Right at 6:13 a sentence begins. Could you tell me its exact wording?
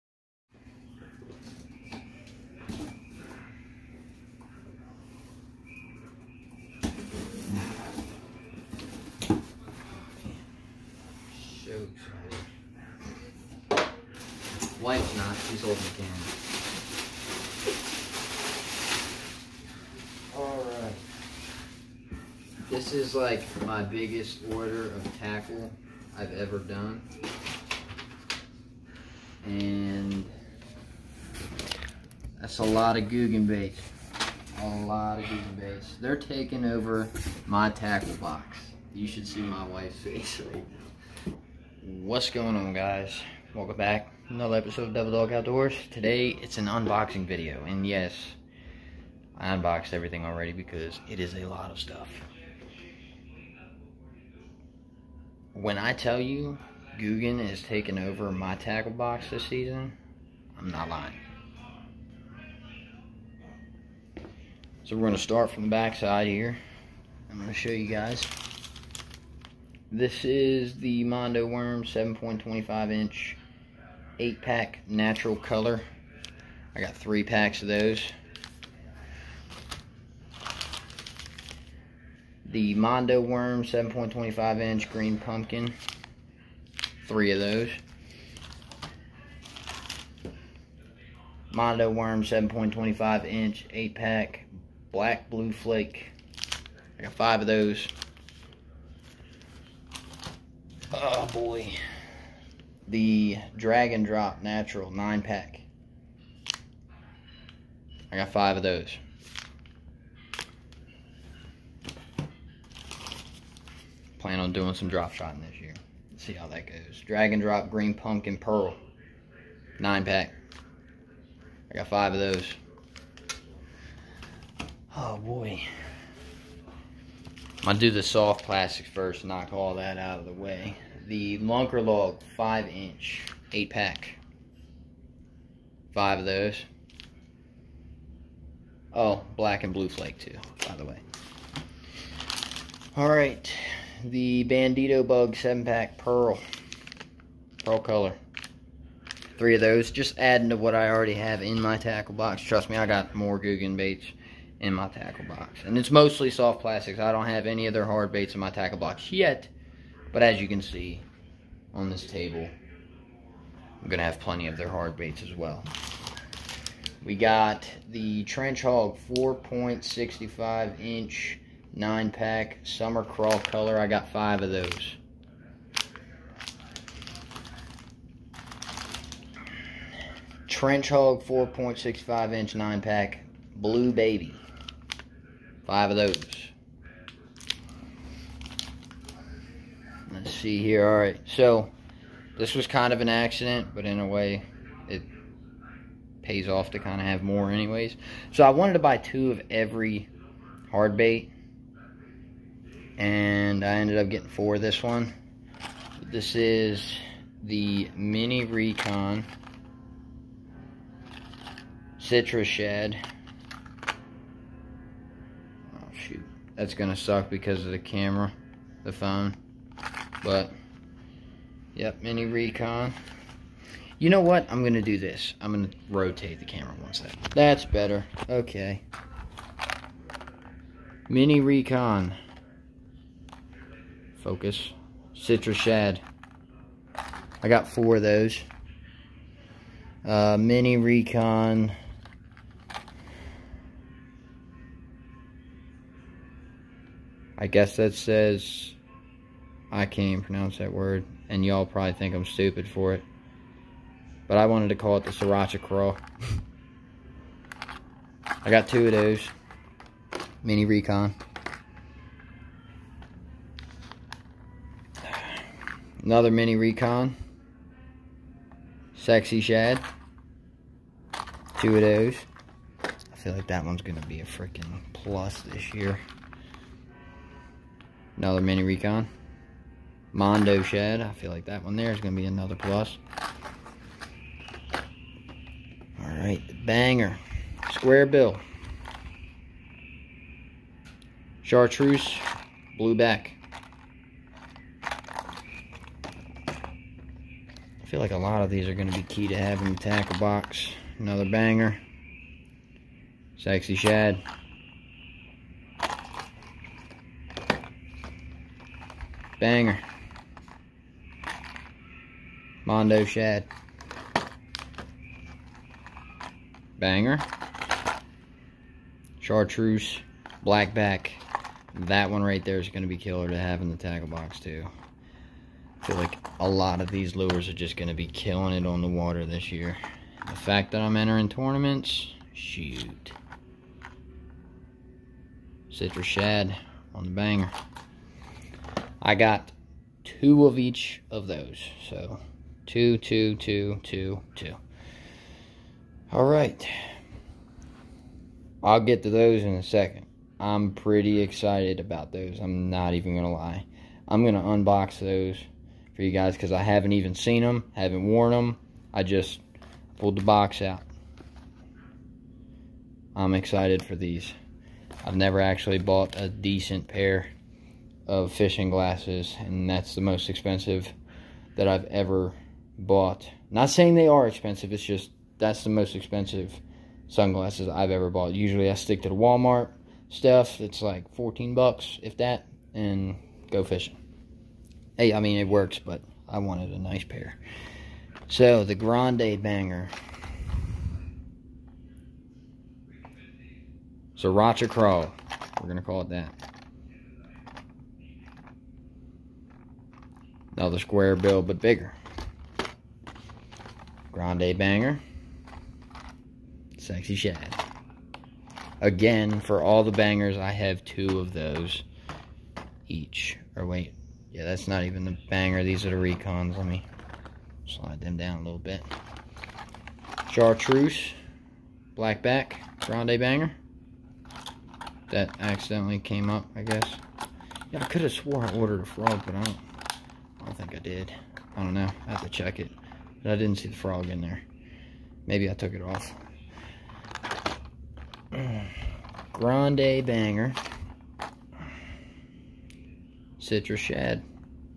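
Not saying they are expensive, it's just that's the most expensive sunglasses I've ever bought.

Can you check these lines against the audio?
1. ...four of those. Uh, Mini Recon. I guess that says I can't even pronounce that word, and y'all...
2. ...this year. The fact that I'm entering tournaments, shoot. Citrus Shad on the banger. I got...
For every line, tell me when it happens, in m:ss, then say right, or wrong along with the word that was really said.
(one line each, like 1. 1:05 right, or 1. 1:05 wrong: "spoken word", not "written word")
1. 3:57 right
2. 5:29 right.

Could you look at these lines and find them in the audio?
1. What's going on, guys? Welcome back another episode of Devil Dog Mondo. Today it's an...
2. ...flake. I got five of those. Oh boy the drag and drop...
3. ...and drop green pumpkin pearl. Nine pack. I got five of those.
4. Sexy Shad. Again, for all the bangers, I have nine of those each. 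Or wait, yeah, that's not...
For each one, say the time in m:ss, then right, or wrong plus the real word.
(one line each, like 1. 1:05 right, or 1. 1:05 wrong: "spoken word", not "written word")
1. 0:42 wrong: "Outdoors", not "Mondo"
2. 1:35 right
3. 1:57 right
4. 6:46 wrong: "two", not "nine".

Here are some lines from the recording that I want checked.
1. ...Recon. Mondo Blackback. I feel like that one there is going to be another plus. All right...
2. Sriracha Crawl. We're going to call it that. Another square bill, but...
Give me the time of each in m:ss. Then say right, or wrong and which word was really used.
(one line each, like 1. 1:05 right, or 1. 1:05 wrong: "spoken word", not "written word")
1. 4:38 wrong: "Shad", not "Blackback"
2. 6:34 right.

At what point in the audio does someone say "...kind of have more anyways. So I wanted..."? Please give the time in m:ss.
3:16.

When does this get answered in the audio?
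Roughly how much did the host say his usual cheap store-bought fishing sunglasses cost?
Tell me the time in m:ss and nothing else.
6:21.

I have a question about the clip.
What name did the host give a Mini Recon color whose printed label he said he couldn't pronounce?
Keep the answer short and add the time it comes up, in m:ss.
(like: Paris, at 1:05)
Sriracha Craw, at 4:15.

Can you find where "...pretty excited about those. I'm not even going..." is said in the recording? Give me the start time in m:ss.
5:50.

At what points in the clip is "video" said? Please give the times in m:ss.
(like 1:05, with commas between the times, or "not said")
0:47.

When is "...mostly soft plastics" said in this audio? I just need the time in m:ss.
2:35.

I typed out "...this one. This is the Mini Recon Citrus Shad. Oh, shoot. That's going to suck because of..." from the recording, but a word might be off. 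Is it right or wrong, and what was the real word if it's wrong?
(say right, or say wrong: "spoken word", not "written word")
right.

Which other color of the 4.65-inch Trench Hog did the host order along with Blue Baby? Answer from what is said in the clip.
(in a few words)
Summer crawl.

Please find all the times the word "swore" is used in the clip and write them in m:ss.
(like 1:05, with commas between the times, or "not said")
7:08.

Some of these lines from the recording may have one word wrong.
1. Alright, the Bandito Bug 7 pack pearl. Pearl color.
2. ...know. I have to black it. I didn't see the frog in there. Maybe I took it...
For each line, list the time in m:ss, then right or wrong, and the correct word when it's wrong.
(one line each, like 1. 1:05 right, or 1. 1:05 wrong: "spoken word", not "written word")
1. 2:22 right
2. 7:11 wrong: "check", not "black".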